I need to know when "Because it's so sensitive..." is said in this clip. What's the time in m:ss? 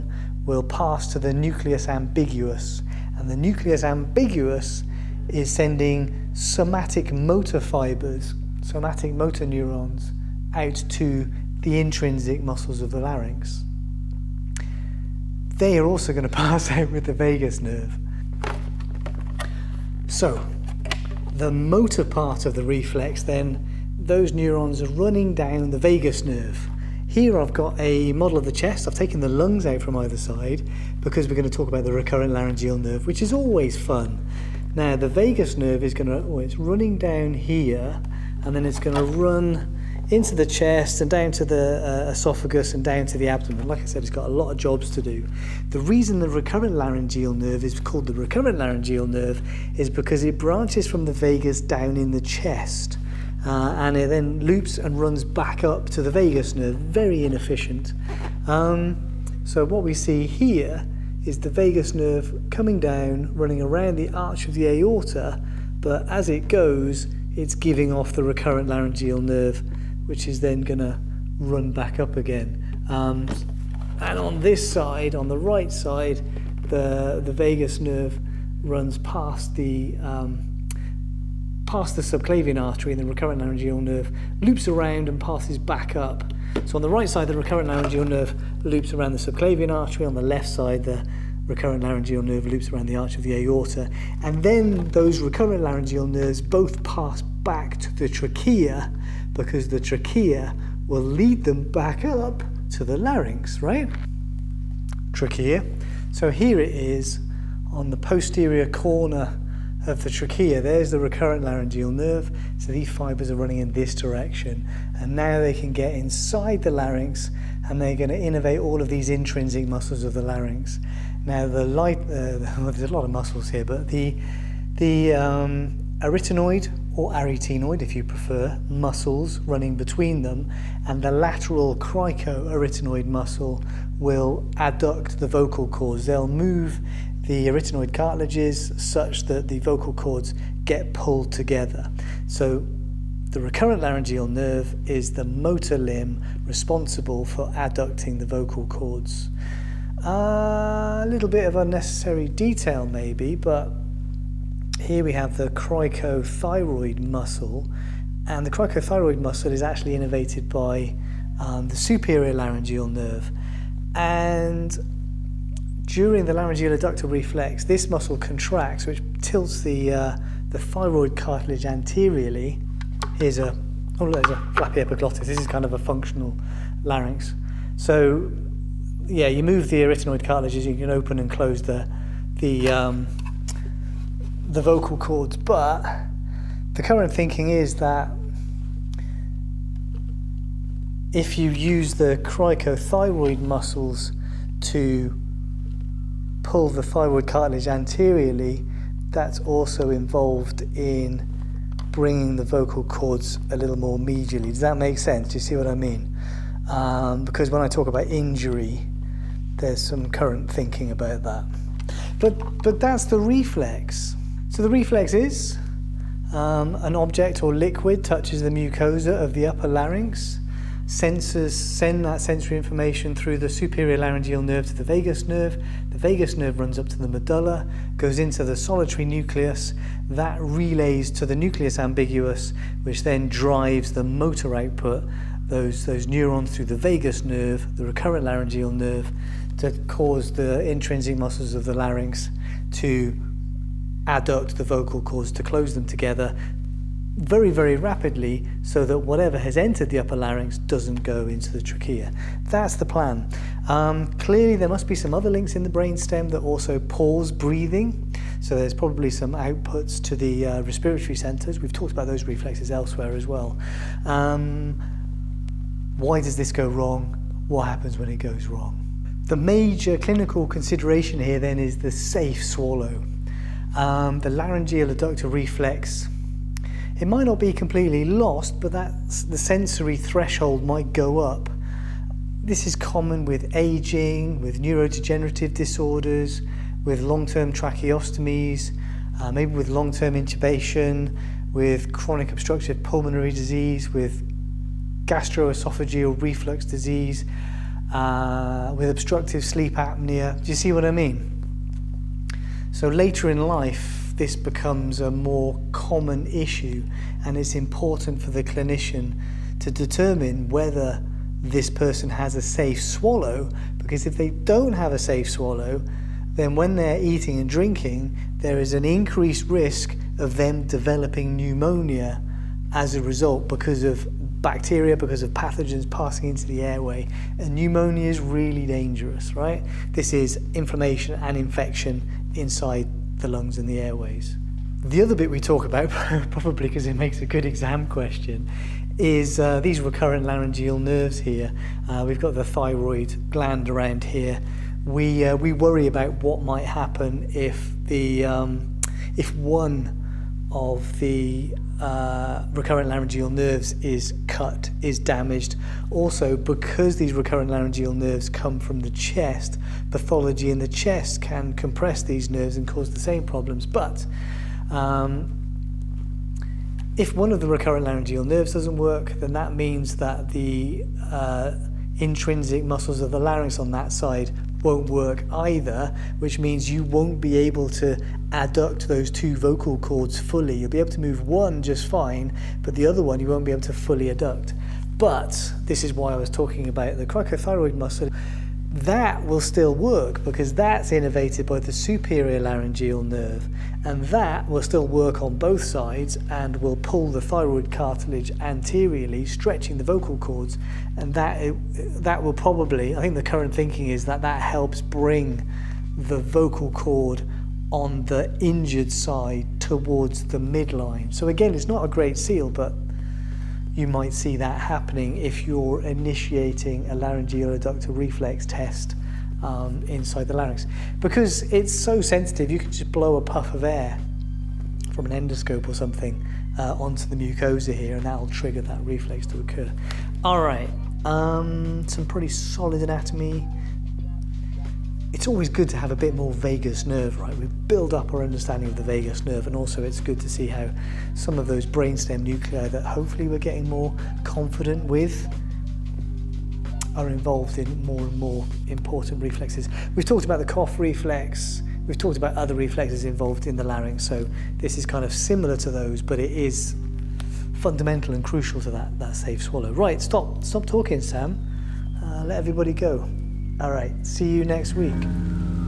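7:00.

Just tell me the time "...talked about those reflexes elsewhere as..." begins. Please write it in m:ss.
4:21.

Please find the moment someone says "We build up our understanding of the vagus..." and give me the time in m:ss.
7:17.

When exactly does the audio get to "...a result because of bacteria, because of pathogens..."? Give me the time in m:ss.
5:22.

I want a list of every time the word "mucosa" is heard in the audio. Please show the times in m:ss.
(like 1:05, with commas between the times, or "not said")
3:38, 7:07.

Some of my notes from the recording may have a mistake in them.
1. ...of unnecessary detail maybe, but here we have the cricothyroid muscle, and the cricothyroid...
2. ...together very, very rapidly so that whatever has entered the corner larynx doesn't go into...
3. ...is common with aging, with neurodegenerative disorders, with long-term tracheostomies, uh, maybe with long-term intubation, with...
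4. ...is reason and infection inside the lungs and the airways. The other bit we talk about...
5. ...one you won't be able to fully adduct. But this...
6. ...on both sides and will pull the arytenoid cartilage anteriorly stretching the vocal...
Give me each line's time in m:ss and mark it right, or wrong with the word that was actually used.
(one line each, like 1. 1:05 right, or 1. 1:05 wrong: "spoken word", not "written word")
1. 2:31 right
2. 4:05 wrong: "upper", not "corner"
3. 4:42 right
4. 5:30 wrong: "inflammation", not "reason"
5. 6:23 right
6. 6:35 wrong: "thyroid", not "arytenoid".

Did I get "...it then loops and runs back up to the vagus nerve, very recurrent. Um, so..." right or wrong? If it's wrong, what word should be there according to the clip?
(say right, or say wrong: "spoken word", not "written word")
wrong: "inefficient", not "recurrent".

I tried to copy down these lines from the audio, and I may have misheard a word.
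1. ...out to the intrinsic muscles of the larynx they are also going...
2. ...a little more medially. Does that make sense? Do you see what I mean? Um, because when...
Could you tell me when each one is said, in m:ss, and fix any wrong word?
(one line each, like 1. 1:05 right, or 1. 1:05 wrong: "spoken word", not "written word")
1. 0:10 right
2. 3:23 right.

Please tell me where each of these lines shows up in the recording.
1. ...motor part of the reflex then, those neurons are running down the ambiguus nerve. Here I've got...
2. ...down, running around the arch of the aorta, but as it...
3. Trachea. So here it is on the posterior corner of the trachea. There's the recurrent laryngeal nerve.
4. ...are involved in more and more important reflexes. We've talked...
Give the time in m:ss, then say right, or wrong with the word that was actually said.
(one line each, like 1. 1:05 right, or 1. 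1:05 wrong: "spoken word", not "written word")
1. 0:21 wrong: "vagus", not "ambiguus"
2. 1:02 right
3. 1:45 right
4. 7:26 right.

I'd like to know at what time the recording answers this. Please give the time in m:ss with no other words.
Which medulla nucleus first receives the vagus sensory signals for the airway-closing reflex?
3:48.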